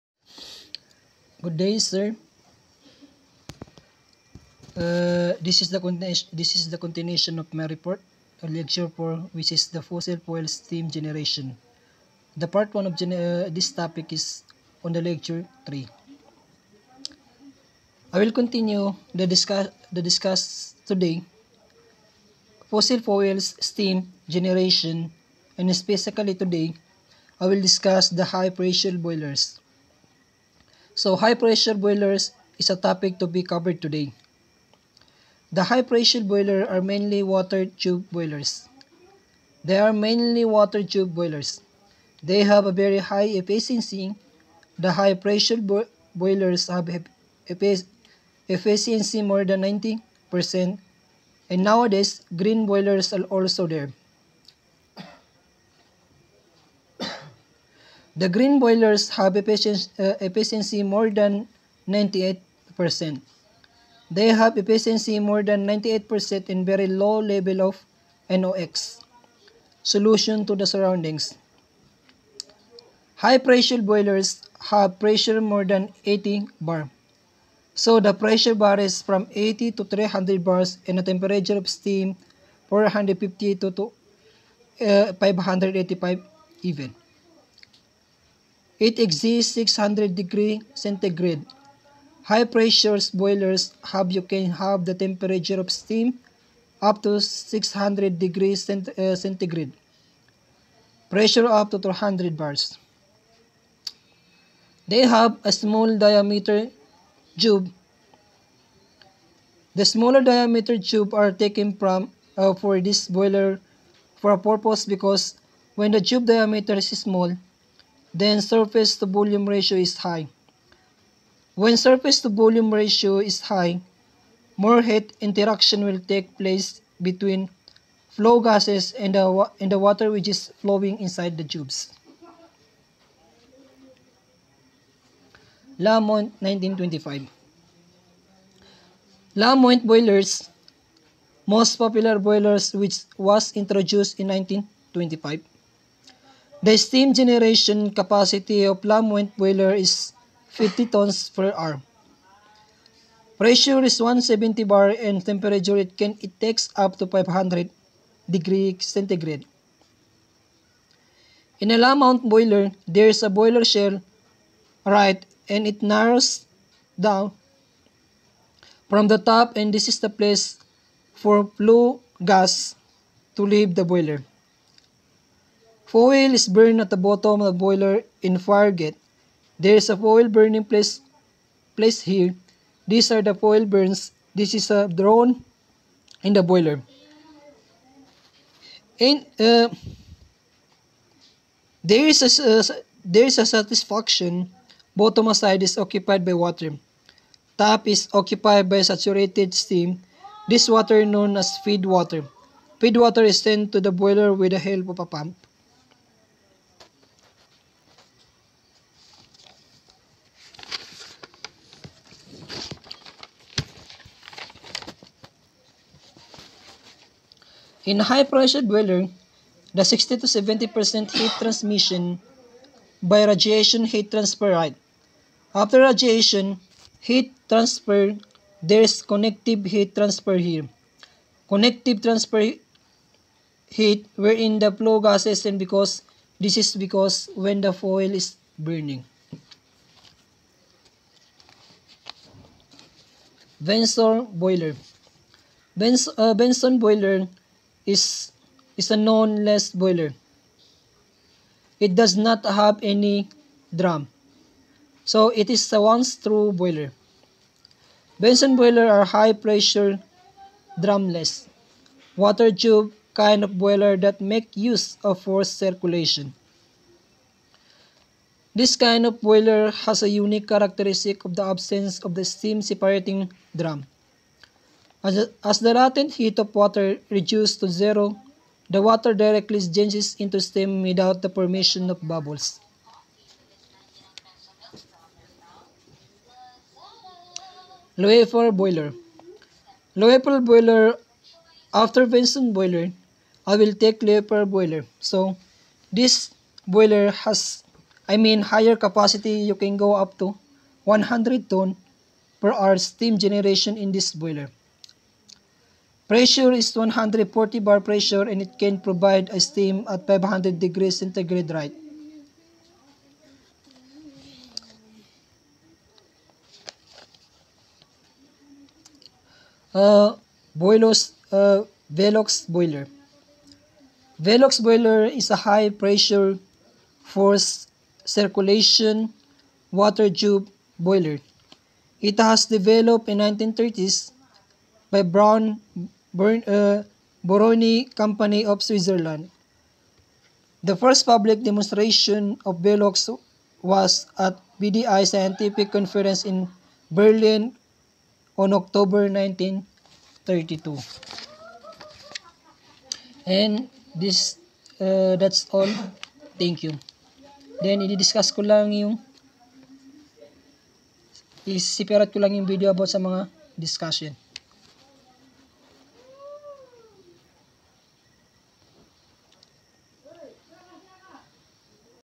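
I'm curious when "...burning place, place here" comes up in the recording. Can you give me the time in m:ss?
3:00.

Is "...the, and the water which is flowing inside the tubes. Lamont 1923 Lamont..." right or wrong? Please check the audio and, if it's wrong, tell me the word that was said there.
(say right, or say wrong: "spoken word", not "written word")
wrong: "1925", not "1923".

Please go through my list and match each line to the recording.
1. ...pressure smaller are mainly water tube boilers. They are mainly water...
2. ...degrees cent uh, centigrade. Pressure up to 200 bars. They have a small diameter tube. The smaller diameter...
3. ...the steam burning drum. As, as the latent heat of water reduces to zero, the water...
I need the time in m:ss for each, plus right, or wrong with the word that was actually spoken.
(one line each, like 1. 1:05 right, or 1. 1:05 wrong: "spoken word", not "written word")
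1. 0:35 wrong: "boiler", not "smaller"
2. 1:38 right
3. 4:32 wrong: "separating", not "burning".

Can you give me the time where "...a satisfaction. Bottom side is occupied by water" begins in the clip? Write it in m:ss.
3:13.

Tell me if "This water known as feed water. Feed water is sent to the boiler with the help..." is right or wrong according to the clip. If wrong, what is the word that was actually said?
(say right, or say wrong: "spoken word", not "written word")
right.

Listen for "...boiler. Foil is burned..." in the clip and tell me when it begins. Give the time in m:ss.
2:53.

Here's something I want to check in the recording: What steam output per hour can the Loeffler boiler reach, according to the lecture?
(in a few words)
100 tons per hour.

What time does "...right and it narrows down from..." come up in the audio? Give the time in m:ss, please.
2:44.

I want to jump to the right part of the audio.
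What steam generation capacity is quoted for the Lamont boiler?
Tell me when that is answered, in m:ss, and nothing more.
2:30.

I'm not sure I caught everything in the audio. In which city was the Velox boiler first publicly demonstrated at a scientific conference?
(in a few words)
Berlin.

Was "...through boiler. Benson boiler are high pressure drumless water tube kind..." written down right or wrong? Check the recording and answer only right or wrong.
right.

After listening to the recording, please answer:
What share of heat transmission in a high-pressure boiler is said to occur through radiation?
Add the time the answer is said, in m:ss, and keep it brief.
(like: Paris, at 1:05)
60 to 70%, at 3:39.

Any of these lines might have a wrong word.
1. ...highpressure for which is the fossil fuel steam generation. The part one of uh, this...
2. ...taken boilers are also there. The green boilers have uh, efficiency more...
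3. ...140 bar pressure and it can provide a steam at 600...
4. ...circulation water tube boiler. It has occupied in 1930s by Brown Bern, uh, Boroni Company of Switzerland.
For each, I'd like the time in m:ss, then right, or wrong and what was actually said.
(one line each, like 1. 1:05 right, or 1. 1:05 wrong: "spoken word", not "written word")
1. 0:08 wrong: "lecture", not "highpressure"
2. 0:52 wrong: "green", not "taken"
3. 5:06 wrong: "500", not "600"
4. 5:28 wrong: "developed", not "occupied".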